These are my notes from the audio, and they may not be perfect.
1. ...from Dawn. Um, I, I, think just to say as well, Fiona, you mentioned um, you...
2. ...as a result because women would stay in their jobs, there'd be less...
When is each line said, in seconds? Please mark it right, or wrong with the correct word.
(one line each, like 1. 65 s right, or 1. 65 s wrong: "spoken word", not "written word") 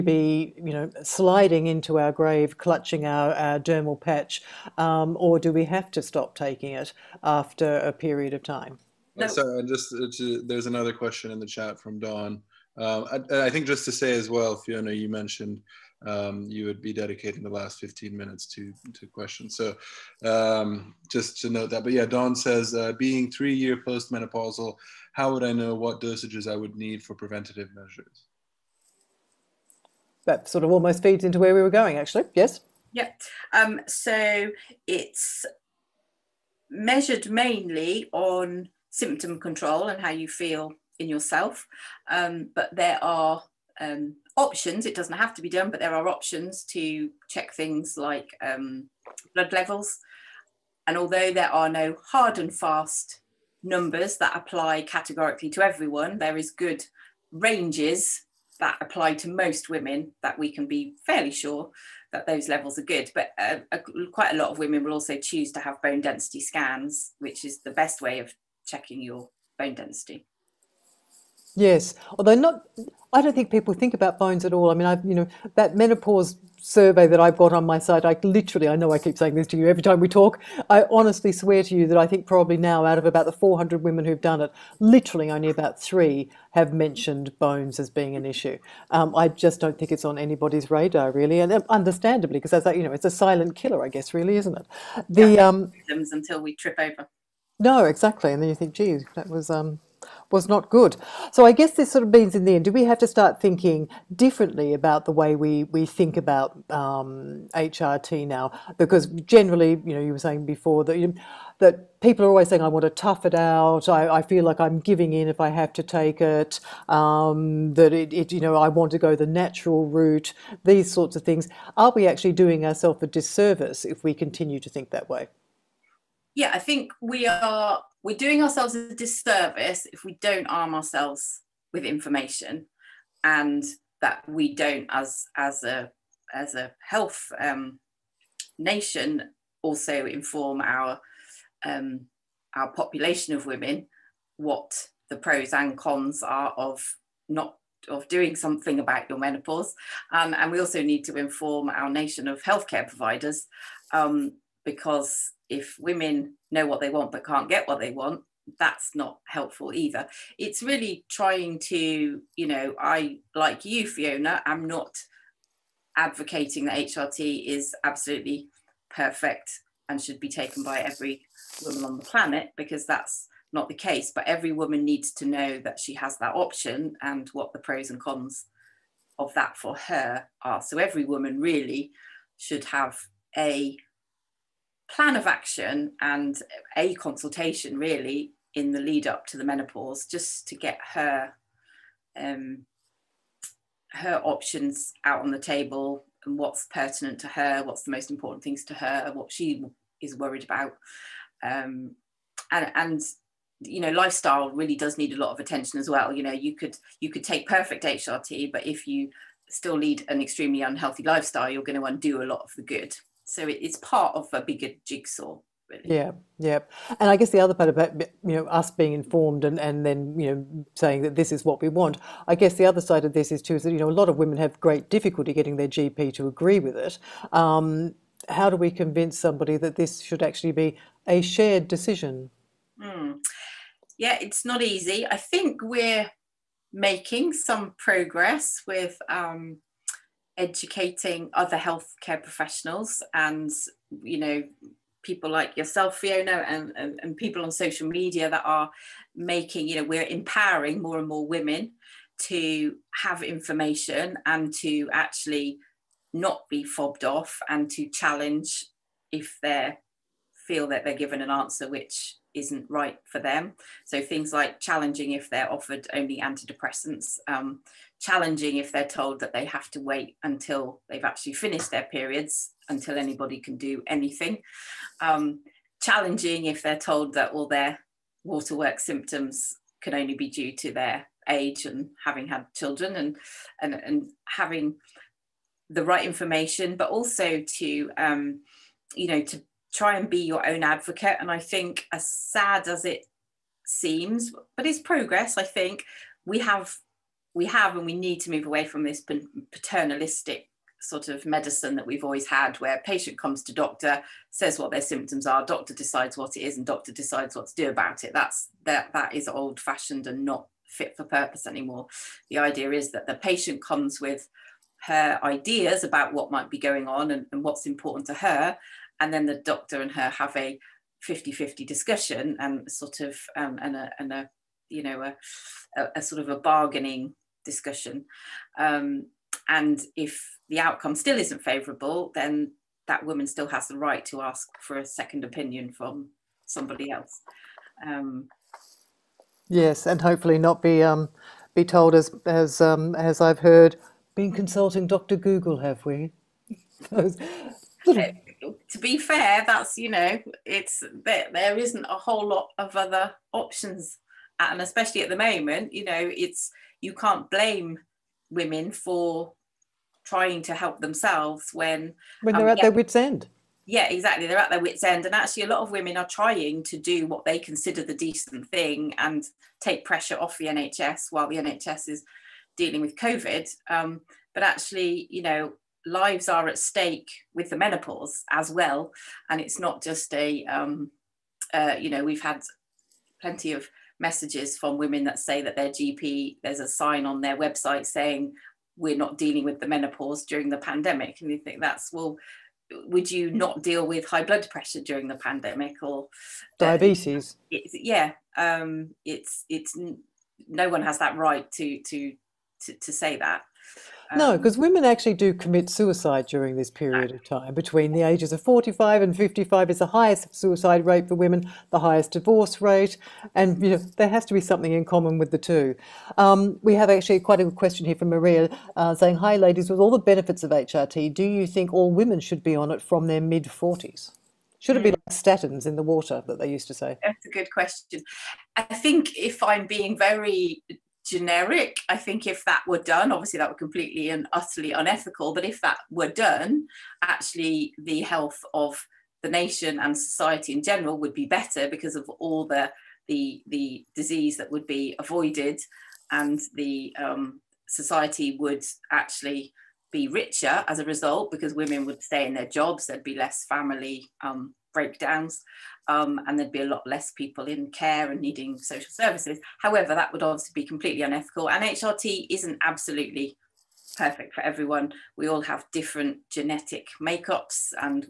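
1. 11 s right
2. 450 s right.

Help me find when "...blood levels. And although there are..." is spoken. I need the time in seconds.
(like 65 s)
49 s.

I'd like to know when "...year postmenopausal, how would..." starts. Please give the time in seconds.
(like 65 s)
23 s.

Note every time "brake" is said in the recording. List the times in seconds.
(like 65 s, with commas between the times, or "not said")
not said.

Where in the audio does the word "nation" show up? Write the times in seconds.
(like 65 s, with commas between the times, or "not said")
138 s, 151 s, 439 s.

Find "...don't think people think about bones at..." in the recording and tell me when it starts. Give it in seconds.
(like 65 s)
73 s.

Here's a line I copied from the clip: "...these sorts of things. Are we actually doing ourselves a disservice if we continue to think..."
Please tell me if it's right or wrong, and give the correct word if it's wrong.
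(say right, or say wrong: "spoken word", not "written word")
right.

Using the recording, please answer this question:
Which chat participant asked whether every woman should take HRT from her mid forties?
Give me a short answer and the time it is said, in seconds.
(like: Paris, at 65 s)
Maria, at 418 s.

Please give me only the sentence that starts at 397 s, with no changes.
Uh, it, yeah, um, it's it's no one has that right to to to, to say that.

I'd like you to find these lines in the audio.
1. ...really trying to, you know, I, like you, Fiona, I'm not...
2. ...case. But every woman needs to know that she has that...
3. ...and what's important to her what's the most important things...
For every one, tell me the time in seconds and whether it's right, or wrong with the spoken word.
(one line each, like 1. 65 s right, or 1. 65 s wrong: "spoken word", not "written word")
1. 160 s right
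2. 173 s right
3. 196 s wrong: "pertinent", not "important".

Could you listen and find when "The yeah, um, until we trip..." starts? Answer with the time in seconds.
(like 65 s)
95 s.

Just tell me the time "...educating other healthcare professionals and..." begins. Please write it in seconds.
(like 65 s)
240 s.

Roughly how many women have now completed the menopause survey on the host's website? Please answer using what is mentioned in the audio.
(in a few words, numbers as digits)
400.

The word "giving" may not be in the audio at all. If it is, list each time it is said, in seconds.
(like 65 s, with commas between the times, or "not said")
114 s.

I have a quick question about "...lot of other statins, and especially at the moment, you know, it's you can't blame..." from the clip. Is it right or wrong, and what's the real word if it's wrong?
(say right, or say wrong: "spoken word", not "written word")
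wrong: "options", not "statins".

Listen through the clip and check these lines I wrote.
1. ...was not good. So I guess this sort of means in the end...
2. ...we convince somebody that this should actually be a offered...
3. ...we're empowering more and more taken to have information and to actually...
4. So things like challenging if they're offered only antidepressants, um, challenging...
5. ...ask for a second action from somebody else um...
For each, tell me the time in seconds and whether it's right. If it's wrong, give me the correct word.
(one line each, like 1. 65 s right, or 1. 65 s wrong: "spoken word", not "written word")
1. 100 s right
2. 228 s wrong: "shared", not "offered"
3. 249 s wrong: "women", not "taken"
4. 263 s right
5. 334 s wrong: "opinion", not "action".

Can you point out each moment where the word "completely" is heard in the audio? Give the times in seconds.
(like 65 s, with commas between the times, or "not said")
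433 s, 460 s.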